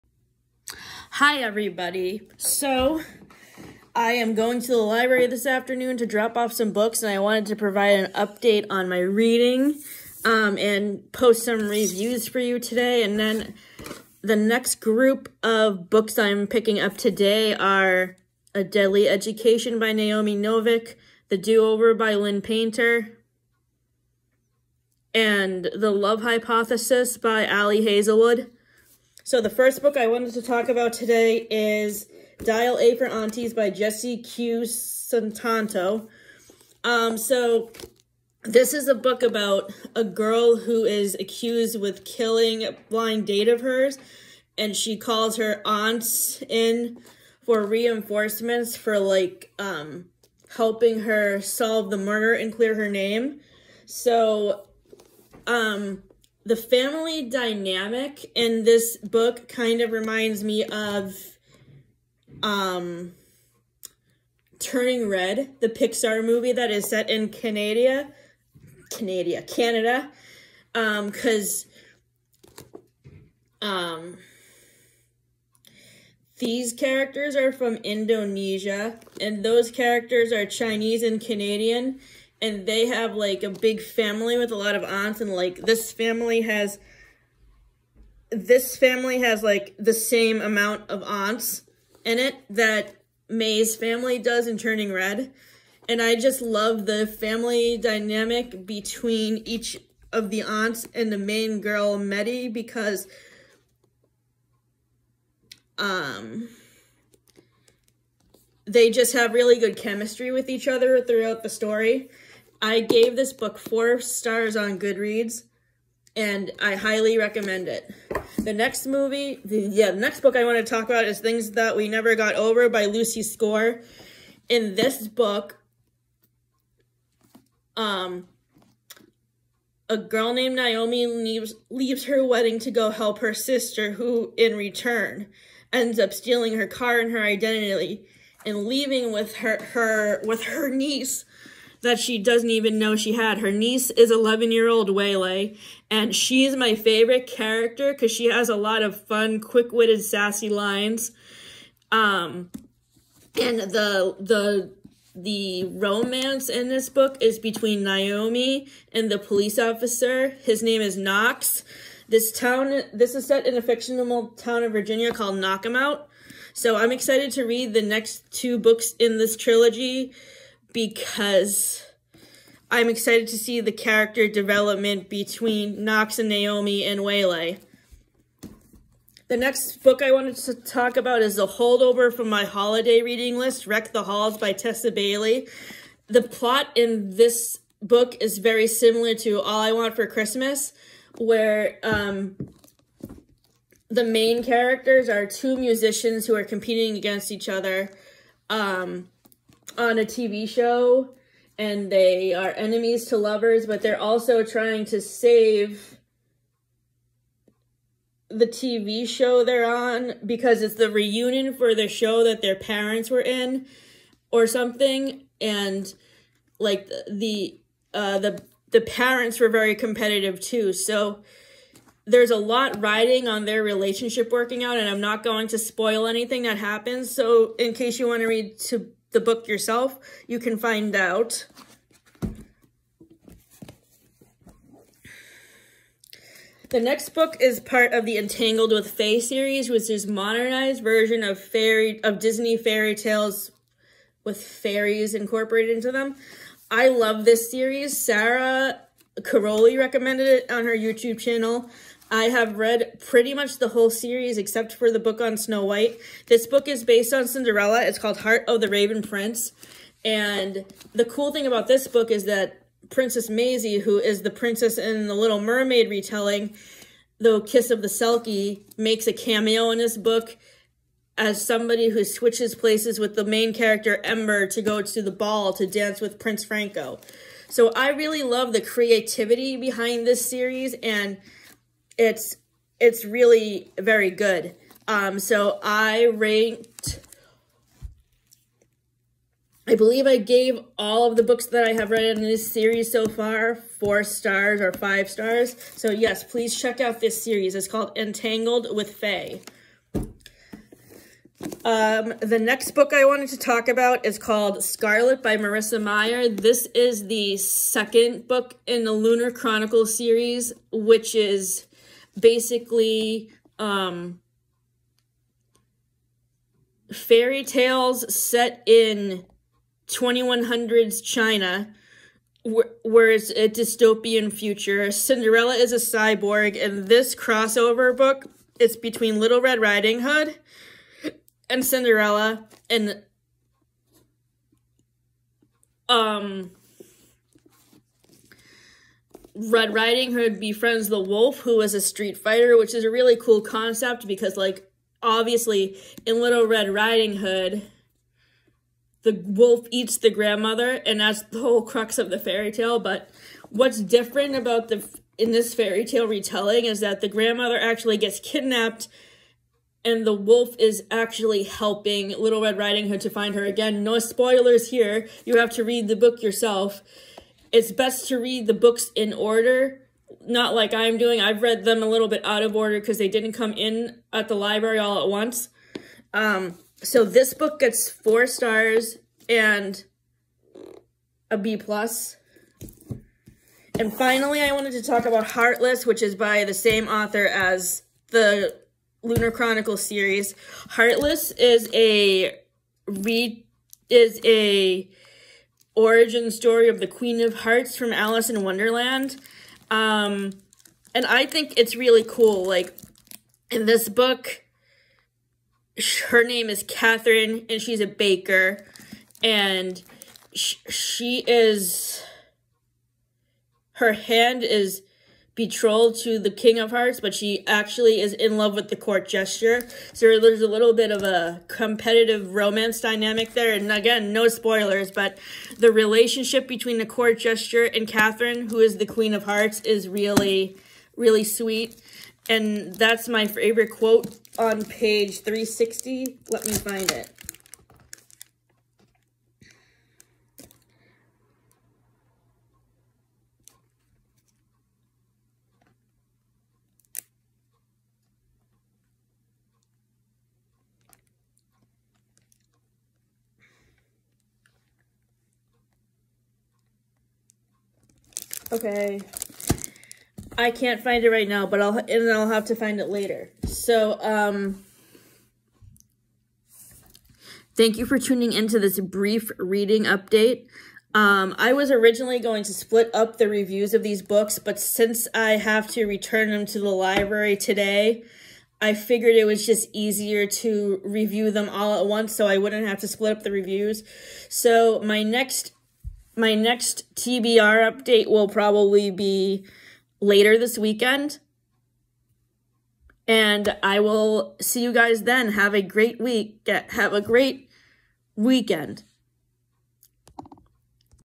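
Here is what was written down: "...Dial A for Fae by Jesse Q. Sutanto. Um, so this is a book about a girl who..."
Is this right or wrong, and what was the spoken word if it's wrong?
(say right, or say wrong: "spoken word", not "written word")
wrong: "Aunties", not "Fae".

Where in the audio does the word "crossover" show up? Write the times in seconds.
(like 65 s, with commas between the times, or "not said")
327 s.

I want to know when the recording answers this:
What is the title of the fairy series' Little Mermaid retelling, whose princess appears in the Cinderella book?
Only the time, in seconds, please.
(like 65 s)
267 s.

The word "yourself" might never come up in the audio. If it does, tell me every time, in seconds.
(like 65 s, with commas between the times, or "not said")
229 s, 366 s.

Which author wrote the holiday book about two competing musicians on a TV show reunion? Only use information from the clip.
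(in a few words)
Tessa Bailey.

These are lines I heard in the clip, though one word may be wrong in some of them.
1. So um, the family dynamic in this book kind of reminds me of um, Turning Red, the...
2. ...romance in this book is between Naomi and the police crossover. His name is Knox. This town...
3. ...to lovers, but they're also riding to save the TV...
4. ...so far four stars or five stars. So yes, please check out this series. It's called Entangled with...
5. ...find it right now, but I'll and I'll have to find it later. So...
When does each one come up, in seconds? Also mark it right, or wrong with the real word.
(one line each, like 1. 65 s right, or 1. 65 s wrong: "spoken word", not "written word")
1. 53 s right
2. 155 s wrong: "officer", not "crossover"
3. 203 s wrong: "trying", not "riding"
4. 292 s right
5. 460 s right.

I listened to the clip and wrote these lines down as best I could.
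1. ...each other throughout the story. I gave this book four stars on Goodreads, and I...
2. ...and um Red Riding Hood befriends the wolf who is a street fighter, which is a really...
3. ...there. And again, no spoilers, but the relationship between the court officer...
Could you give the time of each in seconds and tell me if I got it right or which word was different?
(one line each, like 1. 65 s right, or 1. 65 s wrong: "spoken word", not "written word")
1. 110 s right
2. 332 s right
3. 423 s wrong: "jester", not "officer".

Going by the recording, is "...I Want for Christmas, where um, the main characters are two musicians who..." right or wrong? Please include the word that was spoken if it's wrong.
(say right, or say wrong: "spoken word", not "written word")
right.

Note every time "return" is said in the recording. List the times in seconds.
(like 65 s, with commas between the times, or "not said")
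134 s, 475 s.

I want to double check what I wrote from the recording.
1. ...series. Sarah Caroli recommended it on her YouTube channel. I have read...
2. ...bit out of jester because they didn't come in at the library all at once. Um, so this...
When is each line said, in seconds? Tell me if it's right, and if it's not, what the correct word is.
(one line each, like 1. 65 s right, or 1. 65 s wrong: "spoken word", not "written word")
1. 247 s right
2. 372 s wrong: "order", not "jester".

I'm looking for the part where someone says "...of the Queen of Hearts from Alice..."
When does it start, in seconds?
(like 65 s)
396 s.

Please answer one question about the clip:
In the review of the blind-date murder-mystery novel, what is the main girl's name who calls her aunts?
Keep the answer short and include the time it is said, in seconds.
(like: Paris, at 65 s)
Meddy, at 101 s.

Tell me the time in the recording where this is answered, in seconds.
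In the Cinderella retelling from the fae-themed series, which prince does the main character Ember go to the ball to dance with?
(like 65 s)
276 s.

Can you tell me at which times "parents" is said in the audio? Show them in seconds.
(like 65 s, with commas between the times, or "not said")
212 s, 218 s.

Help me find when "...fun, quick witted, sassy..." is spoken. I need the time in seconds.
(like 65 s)
149 s.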